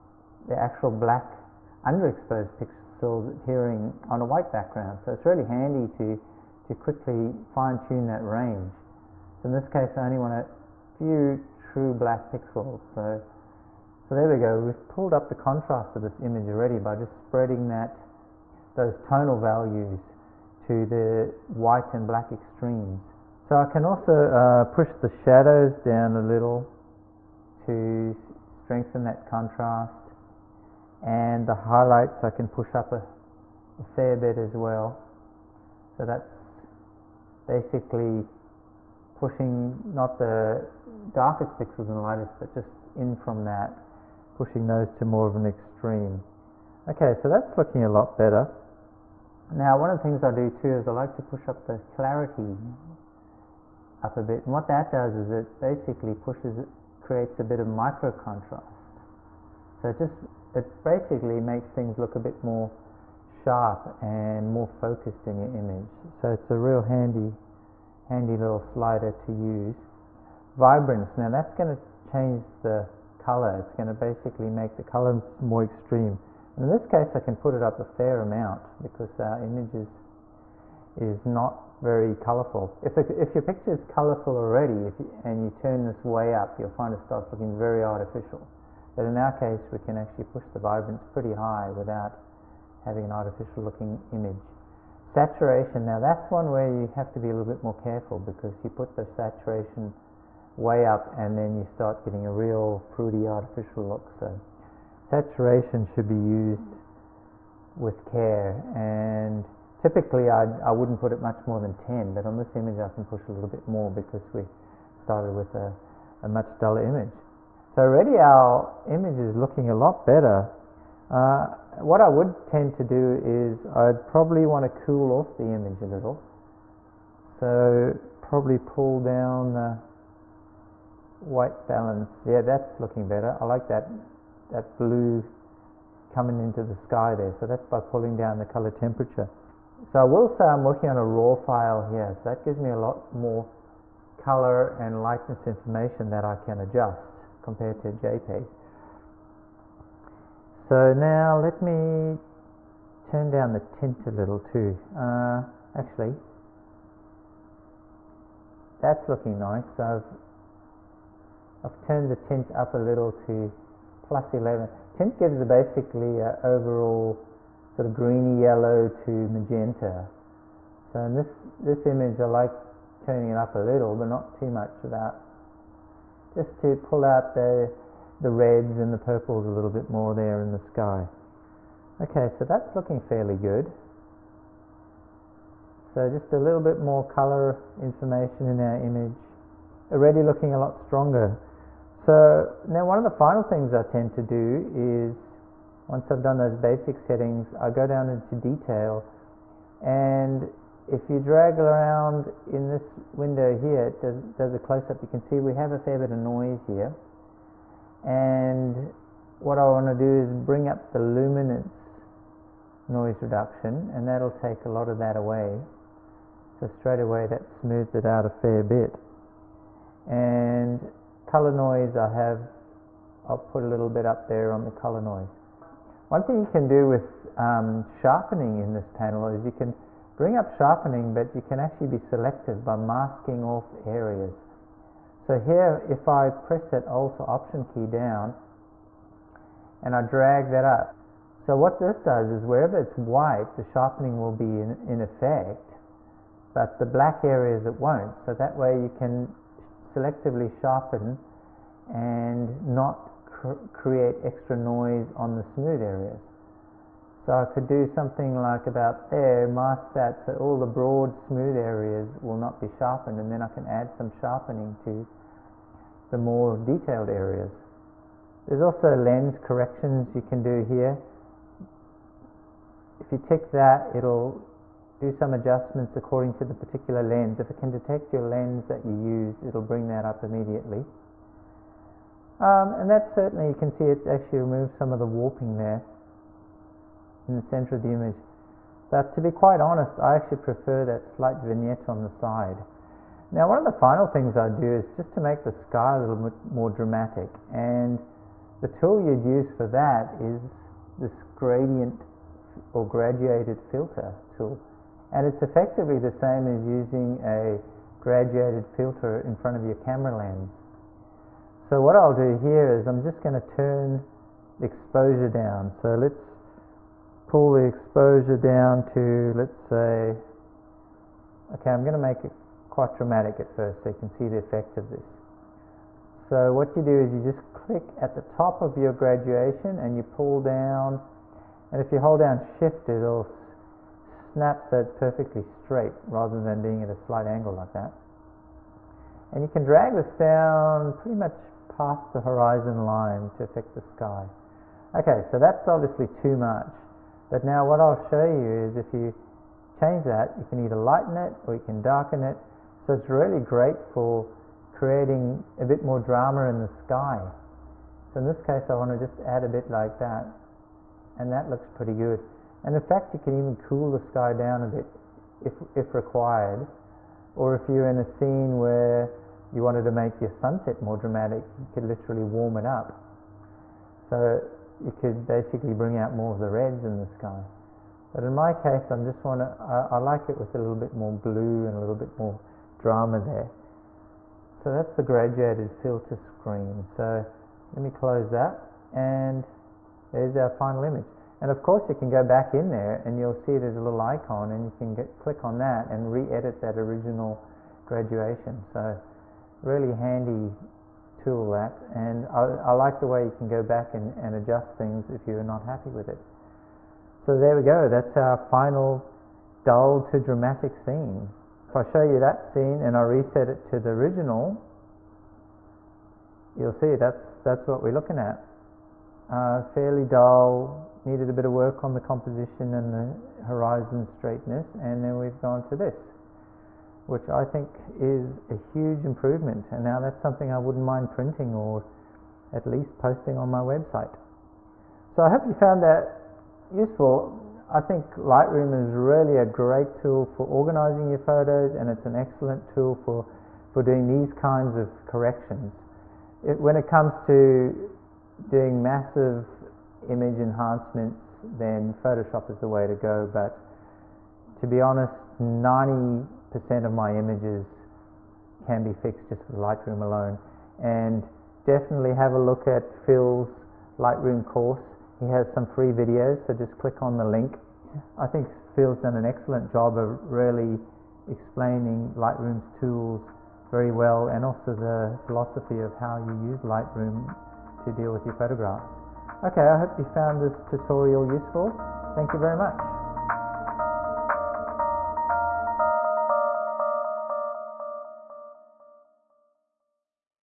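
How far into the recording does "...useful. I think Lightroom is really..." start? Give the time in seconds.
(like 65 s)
436 s.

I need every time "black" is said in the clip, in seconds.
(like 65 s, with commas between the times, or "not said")
0 s, 11 s, 22 s, 246 s.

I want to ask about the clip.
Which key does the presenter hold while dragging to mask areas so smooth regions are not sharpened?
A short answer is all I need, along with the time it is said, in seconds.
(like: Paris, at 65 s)
Alt or Option, at 236 s.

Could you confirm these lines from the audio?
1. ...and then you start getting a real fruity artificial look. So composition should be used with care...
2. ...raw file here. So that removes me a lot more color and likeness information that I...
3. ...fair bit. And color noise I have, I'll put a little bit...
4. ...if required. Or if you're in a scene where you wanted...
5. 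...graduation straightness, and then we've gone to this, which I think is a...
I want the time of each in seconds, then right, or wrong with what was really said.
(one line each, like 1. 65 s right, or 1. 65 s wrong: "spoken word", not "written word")
1. 101 s wrong: "saturation", not "composition"
2. 141 s wrong: "gives", not "removes"
3. 218 s right
4. 365 s right
5. 423 s wrong: "horizon", not "graduation".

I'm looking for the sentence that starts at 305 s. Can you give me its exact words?
And it's effectively the same as using a graduated filter in front of your camera lens.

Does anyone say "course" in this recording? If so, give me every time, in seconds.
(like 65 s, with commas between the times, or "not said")
391 s, 464 s.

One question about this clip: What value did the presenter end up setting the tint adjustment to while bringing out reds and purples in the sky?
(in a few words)
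+11.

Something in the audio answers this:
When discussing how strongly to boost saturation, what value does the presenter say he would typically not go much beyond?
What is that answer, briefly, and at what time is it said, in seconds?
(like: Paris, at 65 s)
10, at 111 s.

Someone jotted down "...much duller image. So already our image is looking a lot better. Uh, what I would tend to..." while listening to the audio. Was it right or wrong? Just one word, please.
right.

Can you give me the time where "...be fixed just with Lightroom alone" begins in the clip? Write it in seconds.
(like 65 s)
458 s.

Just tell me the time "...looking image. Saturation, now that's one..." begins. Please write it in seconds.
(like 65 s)
93 s.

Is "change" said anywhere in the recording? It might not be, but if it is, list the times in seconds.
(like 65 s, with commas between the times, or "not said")
72 s, 349 s.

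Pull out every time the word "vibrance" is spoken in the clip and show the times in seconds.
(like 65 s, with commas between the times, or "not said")
70 s, 90 s.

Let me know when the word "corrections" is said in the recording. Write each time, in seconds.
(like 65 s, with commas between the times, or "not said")
269 s, 445 s.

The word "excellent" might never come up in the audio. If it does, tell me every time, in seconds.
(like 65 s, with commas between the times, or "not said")
442 s, 469 s.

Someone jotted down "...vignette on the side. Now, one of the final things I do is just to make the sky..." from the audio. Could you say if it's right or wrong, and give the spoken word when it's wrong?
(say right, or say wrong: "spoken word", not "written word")
right.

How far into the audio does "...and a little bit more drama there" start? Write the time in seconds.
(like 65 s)
381 s.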